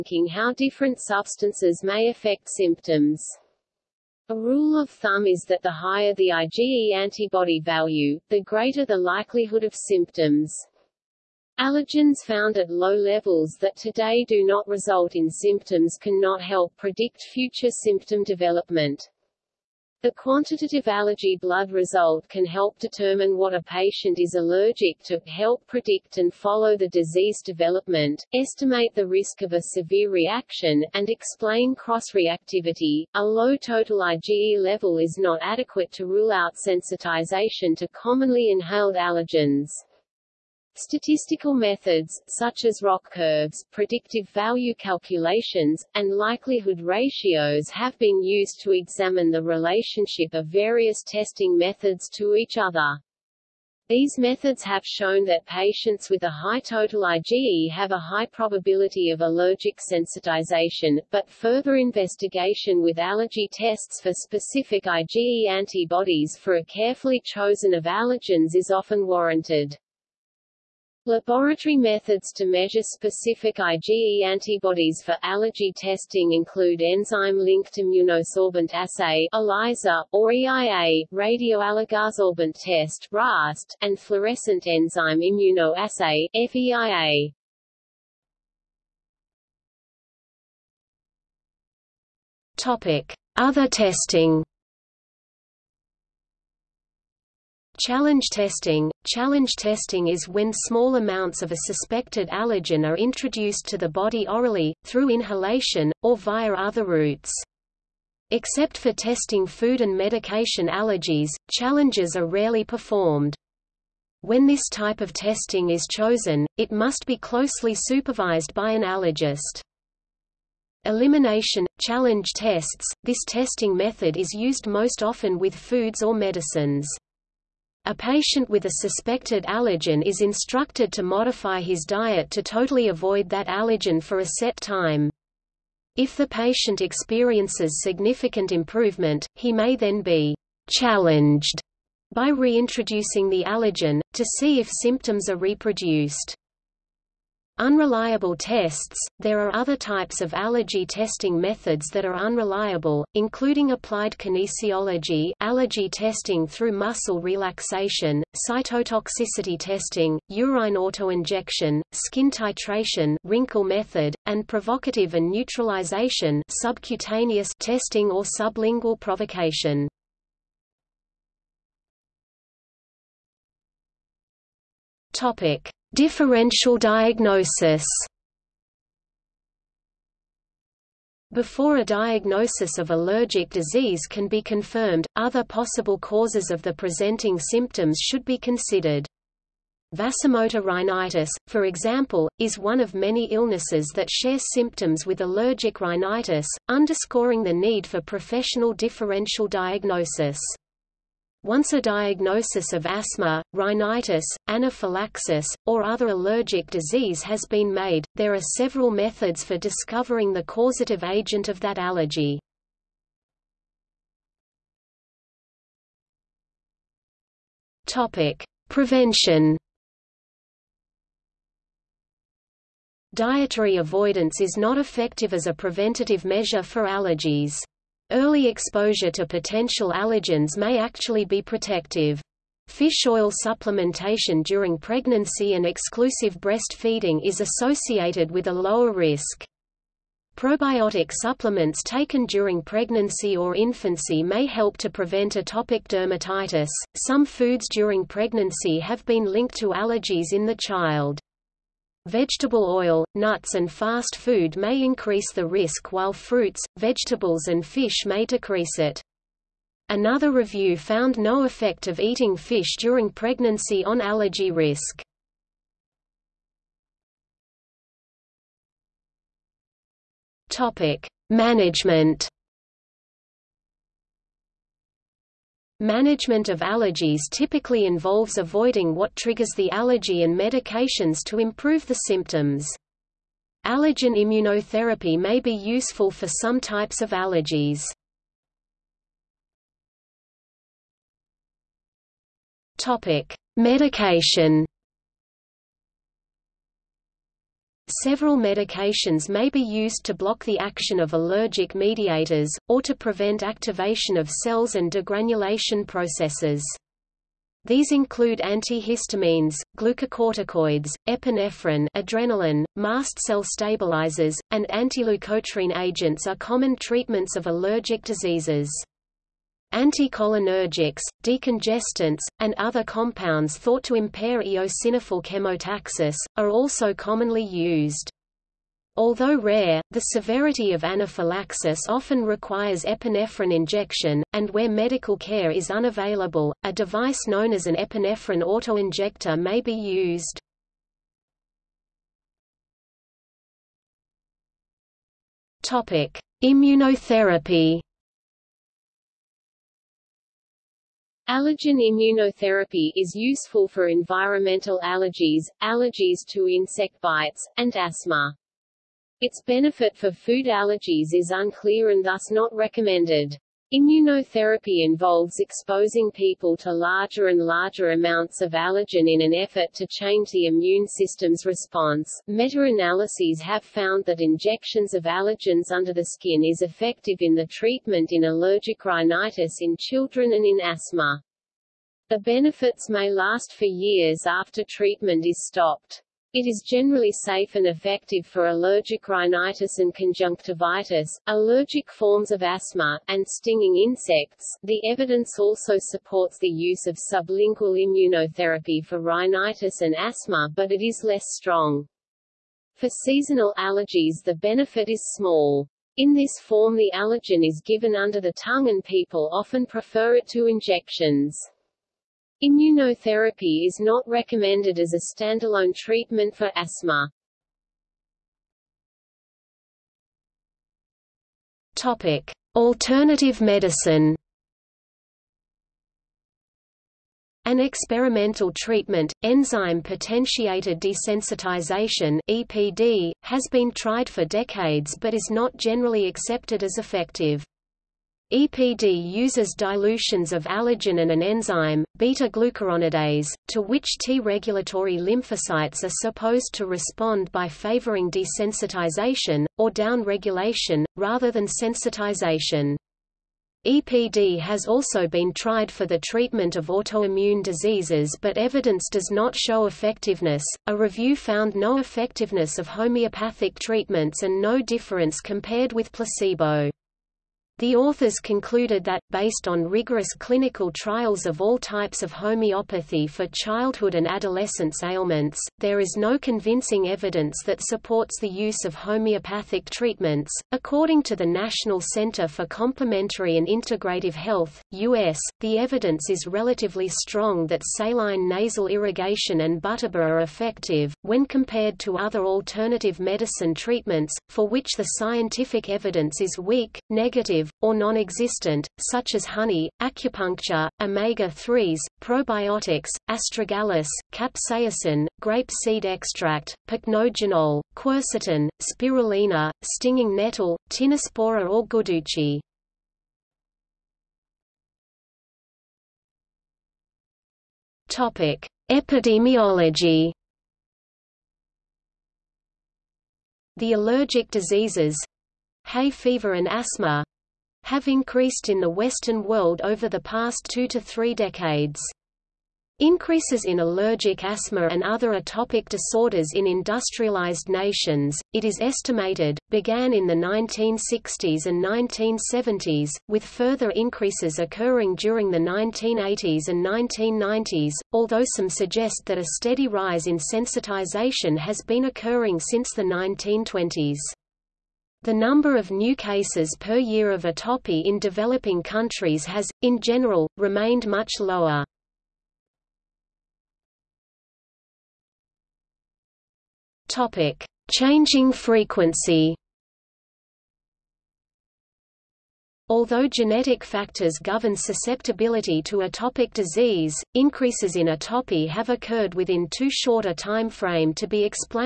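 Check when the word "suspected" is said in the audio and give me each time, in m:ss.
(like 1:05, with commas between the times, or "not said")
1:41, 2:08.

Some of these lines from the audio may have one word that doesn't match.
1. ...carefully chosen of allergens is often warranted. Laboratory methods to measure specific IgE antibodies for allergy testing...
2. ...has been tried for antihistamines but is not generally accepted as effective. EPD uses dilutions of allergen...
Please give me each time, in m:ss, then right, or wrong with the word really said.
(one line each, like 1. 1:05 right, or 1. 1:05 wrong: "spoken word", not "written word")
1. 1:06 right
2. 7:13 wrong: "decades", not "antihistamines".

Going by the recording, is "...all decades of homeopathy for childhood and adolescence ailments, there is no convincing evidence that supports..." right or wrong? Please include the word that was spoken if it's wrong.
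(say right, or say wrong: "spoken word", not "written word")
wrong: "types", not "decades".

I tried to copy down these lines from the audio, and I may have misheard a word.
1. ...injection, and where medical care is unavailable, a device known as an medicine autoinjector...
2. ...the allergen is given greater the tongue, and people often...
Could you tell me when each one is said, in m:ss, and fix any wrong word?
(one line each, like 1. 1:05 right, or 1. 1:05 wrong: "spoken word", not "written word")
1. 5:33 wrong: "epinephrine", not "medicine"
2. 6:46 wrong: "under", not "greater".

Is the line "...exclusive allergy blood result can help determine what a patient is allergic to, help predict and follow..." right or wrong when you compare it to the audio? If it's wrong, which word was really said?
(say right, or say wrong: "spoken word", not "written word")
wrong: "quantitative", not "exclusive".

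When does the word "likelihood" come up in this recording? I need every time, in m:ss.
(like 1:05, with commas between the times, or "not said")
0:08, 0:46.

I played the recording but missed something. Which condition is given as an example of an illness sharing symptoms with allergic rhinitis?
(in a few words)
Vasomotor rhinitis.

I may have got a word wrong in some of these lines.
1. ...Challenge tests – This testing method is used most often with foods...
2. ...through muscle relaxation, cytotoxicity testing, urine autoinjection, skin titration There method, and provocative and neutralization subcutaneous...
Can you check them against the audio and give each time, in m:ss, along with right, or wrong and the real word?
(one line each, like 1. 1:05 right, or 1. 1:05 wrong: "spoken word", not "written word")
1. 2:01 right
2. 2:36 wrong: "Rinkel", not "There".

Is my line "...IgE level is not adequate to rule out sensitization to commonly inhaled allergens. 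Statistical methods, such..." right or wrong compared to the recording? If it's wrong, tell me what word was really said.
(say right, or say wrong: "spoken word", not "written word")
right.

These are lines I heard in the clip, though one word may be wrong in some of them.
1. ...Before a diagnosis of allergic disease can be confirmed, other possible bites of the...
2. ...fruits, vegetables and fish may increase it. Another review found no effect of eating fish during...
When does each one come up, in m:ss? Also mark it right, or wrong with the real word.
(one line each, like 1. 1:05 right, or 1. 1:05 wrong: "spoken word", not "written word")
1. 3:01 wrong: "causes", not "bites"
2. 4:16 wrong: "decrease", not "increase".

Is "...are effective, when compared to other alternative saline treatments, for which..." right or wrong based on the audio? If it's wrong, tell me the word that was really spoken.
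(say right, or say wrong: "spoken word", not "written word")
wrong: "medicine", not "saline".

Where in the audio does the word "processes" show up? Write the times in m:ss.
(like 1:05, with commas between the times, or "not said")
5:05.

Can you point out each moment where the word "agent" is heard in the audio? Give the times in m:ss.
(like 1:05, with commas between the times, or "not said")
3:31, 5:15.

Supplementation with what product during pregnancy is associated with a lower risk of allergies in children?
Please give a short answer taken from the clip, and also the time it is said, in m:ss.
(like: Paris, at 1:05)
Fish oil, at 3:52.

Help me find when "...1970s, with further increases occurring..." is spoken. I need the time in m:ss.
9:01.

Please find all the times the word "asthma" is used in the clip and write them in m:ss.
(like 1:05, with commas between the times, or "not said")
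3:22, 5:57, 6:20, 6:32, 6:39, 6:56, 8:46, 8:54.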